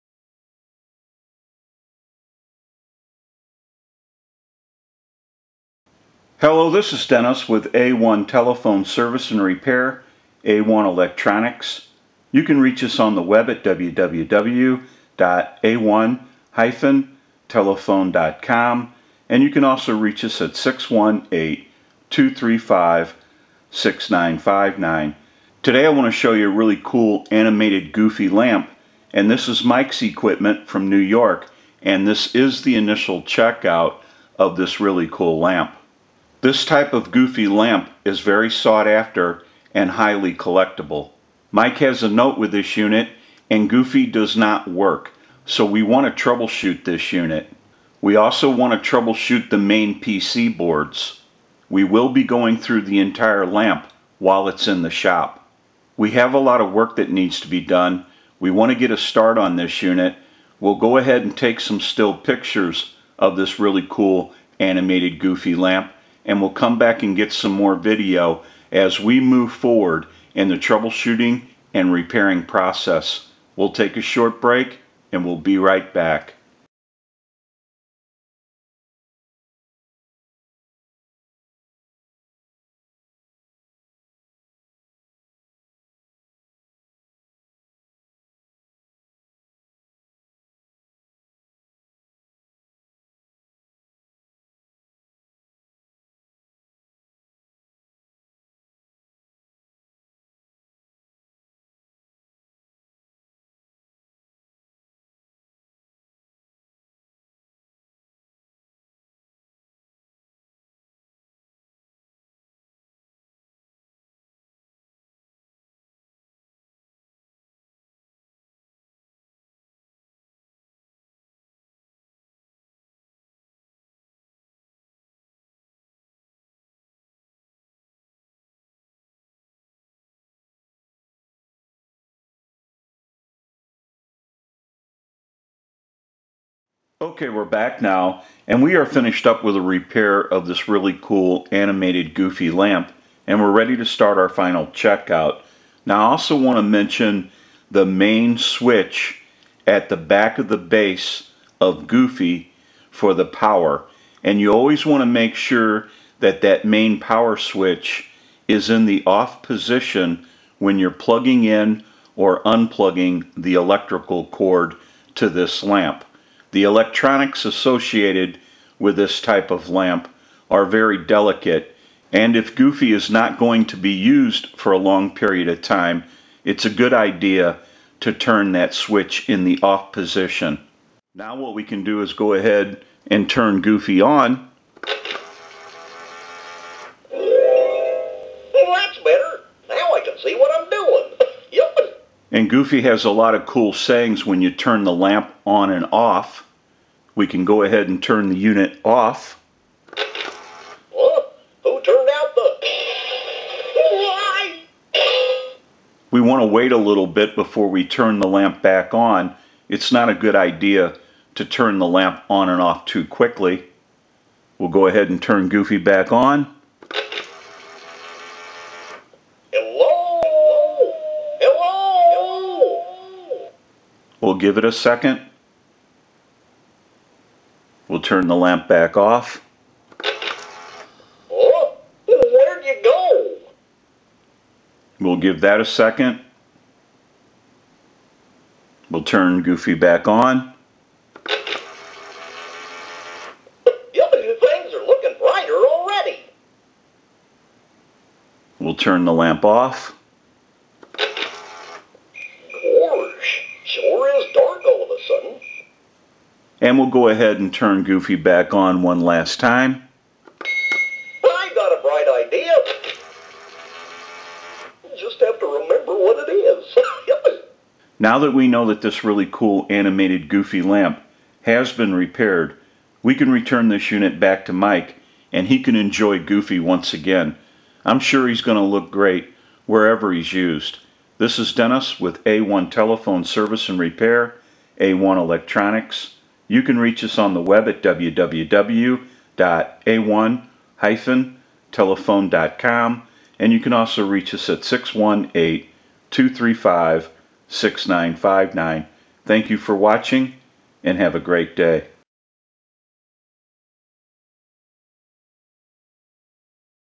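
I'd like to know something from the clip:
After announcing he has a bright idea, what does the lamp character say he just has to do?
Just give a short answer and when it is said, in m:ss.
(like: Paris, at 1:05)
remember what it is, at 4:25.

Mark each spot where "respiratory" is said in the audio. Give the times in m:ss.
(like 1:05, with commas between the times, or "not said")
not said.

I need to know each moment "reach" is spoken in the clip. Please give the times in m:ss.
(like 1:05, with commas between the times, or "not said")
0:12, 0:19, 4:46, 4:54.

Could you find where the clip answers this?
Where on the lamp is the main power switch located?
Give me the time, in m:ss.
2:29.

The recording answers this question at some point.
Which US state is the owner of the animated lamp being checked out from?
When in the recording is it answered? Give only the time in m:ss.
0:30.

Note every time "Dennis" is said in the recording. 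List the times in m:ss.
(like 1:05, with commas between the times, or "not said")
0:07, 4:41.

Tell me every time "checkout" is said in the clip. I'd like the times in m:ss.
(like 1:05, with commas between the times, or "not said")
0:33, 2:24.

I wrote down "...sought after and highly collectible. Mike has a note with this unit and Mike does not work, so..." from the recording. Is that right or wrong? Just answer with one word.
wrong.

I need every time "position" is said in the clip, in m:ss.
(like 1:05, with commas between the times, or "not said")
2:39, 2:59.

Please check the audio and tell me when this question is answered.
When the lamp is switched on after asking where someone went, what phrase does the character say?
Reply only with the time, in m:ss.
4:04.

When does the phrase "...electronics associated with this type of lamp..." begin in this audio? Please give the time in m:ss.
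2:46.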